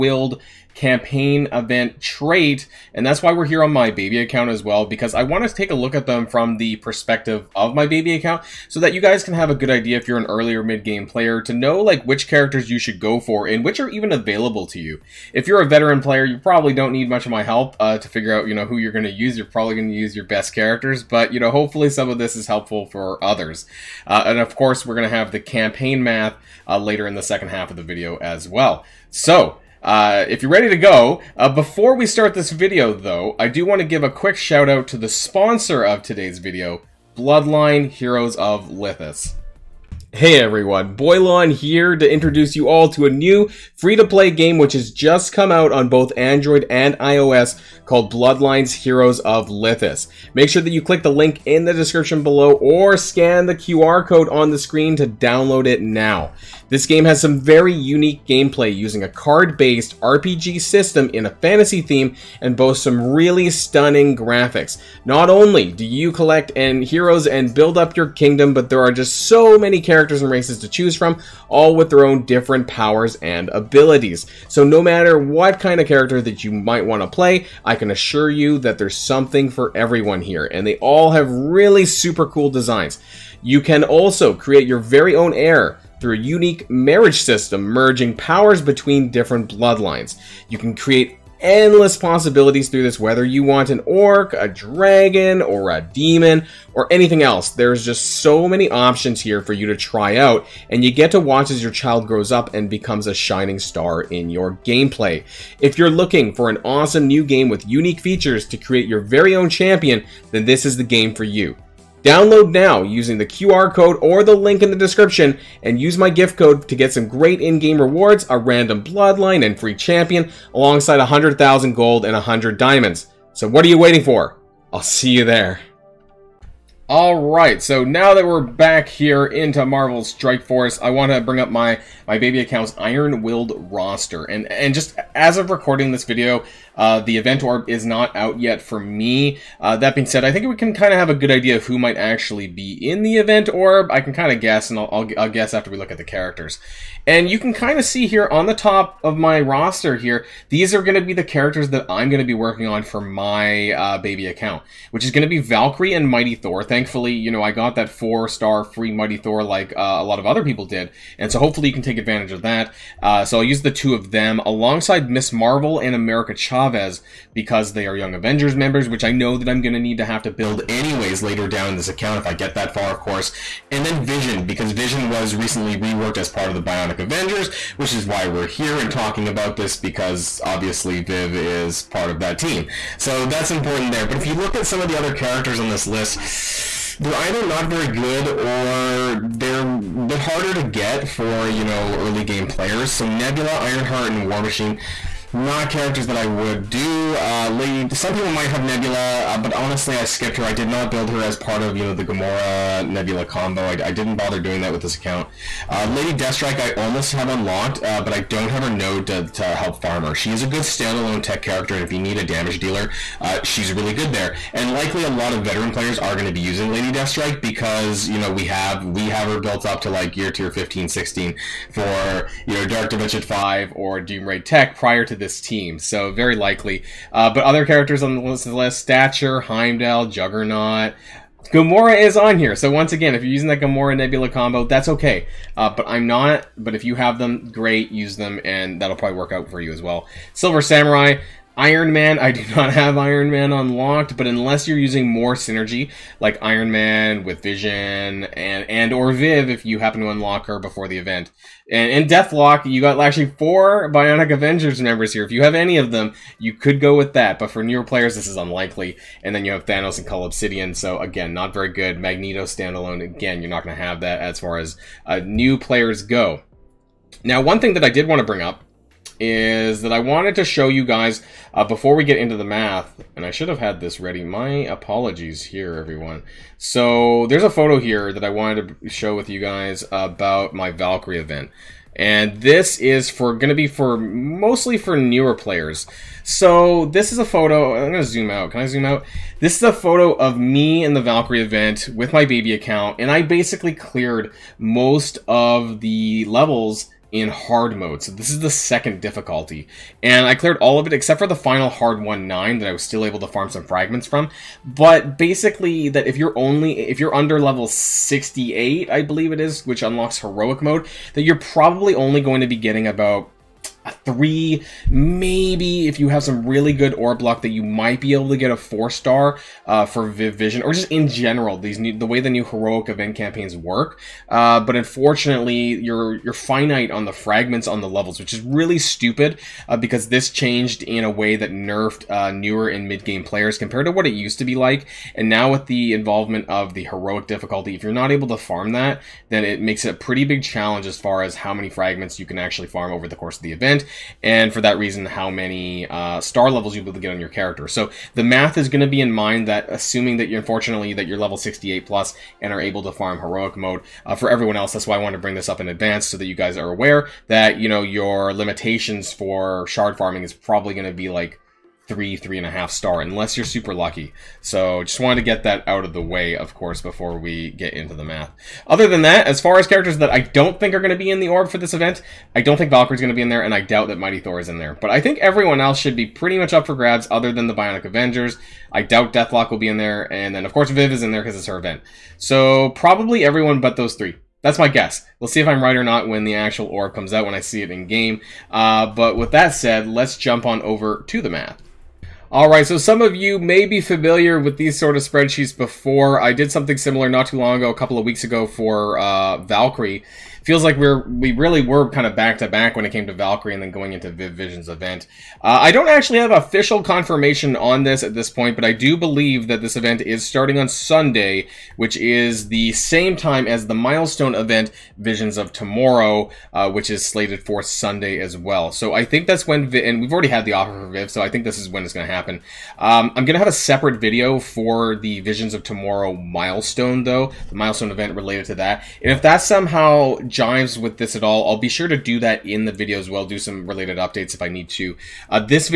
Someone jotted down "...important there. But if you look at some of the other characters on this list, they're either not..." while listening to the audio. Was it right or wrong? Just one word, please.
right.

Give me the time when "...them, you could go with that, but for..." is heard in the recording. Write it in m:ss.
4:15.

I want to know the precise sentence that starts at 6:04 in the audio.
So just wanted to get that out of the way, of course, before we get into the math.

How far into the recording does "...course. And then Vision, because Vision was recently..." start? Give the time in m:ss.
2:52.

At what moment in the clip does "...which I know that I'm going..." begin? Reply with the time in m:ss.
2:48.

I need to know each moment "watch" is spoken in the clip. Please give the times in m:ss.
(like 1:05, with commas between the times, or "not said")
1:41.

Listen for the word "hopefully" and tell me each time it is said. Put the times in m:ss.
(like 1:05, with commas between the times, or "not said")
0:21, 2:41.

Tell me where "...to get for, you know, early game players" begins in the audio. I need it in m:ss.
3:10.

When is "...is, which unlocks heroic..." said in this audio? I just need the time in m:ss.
5:09.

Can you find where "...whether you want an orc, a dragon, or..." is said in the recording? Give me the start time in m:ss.
1:32.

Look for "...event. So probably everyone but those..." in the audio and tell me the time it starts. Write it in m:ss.
6:21.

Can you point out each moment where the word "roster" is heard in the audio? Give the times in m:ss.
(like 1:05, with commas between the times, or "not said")
2:13, 2:29.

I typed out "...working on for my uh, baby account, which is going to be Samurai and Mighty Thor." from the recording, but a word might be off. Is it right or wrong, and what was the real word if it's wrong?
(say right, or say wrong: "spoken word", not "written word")
wrong: "Valkyrie", not "Samurai".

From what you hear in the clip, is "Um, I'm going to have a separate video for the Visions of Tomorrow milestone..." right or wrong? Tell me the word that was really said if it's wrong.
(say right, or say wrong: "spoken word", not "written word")
right.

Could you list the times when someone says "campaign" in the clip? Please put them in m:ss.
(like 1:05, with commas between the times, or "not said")
0:00, 0:25, 5:23.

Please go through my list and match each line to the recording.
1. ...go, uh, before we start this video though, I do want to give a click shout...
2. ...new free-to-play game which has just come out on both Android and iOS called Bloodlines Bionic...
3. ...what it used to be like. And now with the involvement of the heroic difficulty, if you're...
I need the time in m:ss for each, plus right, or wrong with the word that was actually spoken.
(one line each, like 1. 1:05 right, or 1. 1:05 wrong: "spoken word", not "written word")
1. 0:30 wrong: "quick", not "click"
2. 0:43 wrong: "Heroes", not "Bionic"
3. 5:33 right.